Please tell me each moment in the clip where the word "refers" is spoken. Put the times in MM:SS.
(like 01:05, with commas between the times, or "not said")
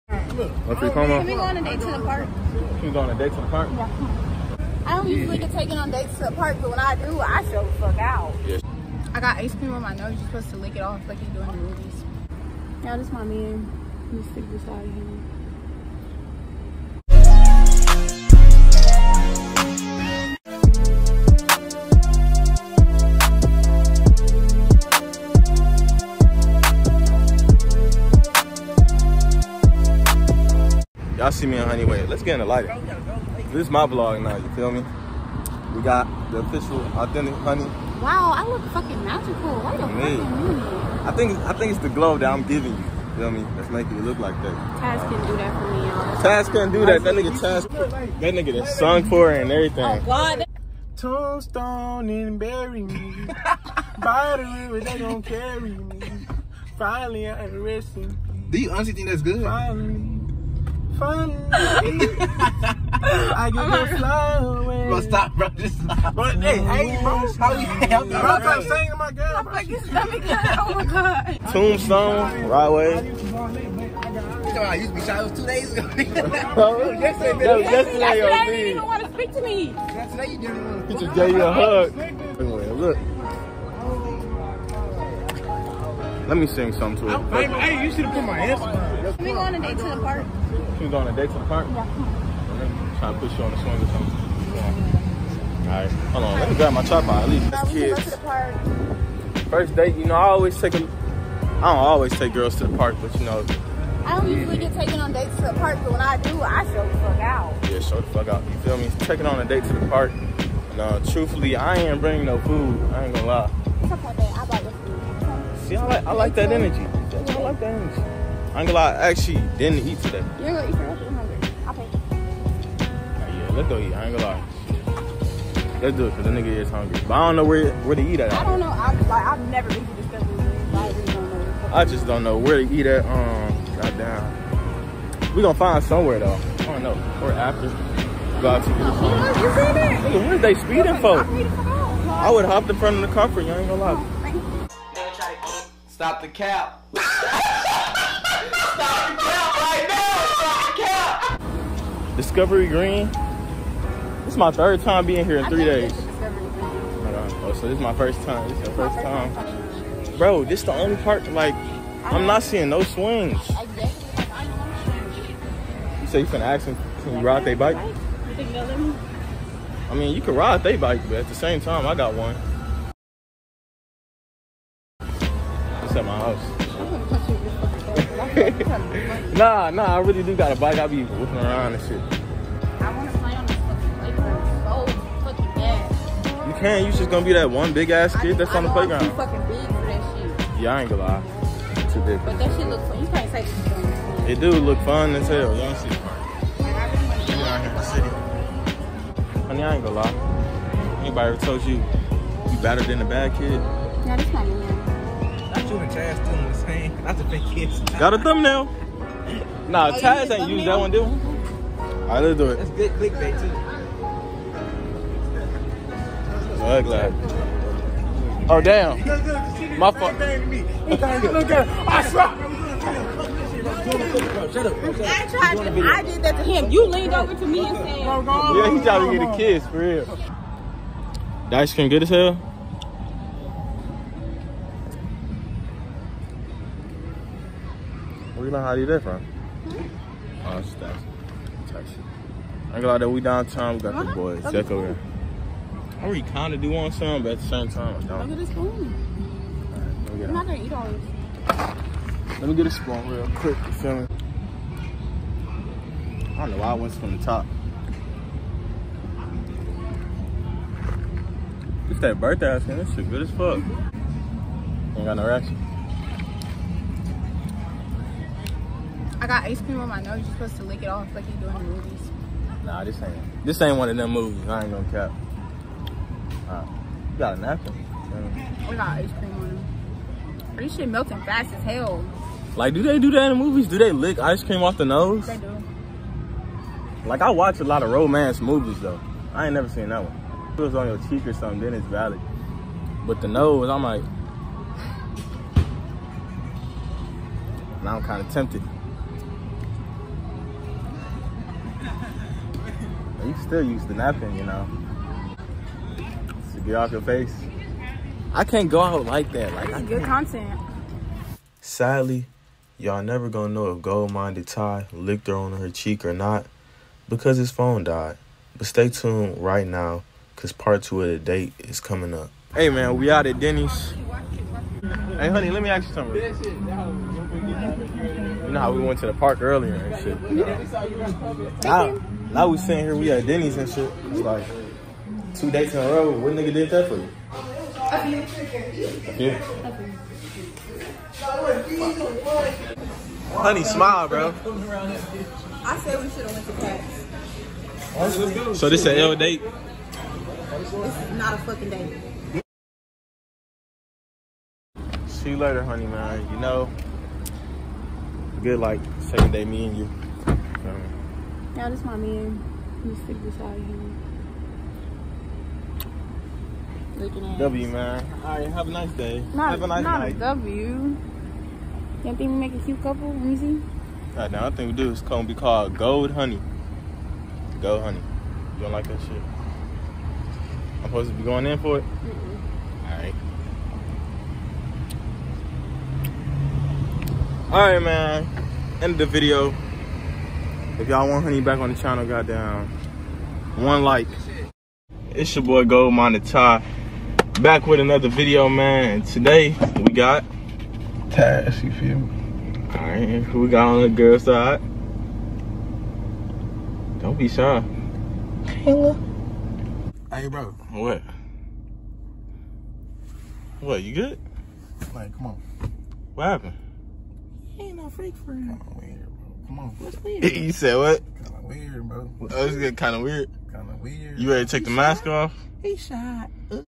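not said.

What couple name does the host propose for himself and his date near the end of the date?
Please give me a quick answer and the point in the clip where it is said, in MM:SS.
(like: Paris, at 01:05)
Gold Honey, at 06:14.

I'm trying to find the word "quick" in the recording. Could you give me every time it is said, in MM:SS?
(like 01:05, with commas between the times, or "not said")
04:13.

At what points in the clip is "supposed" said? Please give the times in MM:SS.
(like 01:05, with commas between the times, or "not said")
00:10, 04:30, 06:20.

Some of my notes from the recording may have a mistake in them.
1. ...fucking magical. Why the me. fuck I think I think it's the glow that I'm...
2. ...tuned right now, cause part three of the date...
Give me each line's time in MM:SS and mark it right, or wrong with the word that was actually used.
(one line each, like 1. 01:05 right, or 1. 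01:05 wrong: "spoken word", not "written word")
1. 00:38 right
2. 05:18 wrong: "two", not "three".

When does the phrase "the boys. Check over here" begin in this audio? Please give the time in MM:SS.
04:04.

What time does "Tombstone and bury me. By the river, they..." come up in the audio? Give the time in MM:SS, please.
00:50.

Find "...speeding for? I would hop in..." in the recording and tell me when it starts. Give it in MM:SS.
02:20.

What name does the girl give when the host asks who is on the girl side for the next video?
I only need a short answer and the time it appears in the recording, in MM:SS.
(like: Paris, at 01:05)
Kayla, at 06:48.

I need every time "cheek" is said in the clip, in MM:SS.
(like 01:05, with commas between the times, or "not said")
04:51, 05:15.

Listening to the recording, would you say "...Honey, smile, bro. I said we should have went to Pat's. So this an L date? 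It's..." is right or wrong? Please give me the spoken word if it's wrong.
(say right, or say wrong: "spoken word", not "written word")
right.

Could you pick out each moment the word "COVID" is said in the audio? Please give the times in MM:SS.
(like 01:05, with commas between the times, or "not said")
not said.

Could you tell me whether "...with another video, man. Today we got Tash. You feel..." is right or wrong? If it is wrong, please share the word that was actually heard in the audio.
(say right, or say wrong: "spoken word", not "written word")
right.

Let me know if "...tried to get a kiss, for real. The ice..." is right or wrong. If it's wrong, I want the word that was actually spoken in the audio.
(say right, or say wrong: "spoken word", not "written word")
right.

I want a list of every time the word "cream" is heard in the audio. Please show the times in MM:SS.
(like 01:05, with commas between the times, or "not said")
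00:09, 03:51, 04:29, 04:39, 04:44.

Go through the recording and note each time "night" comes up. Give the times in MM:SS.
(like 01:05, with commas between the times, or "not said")
06:09.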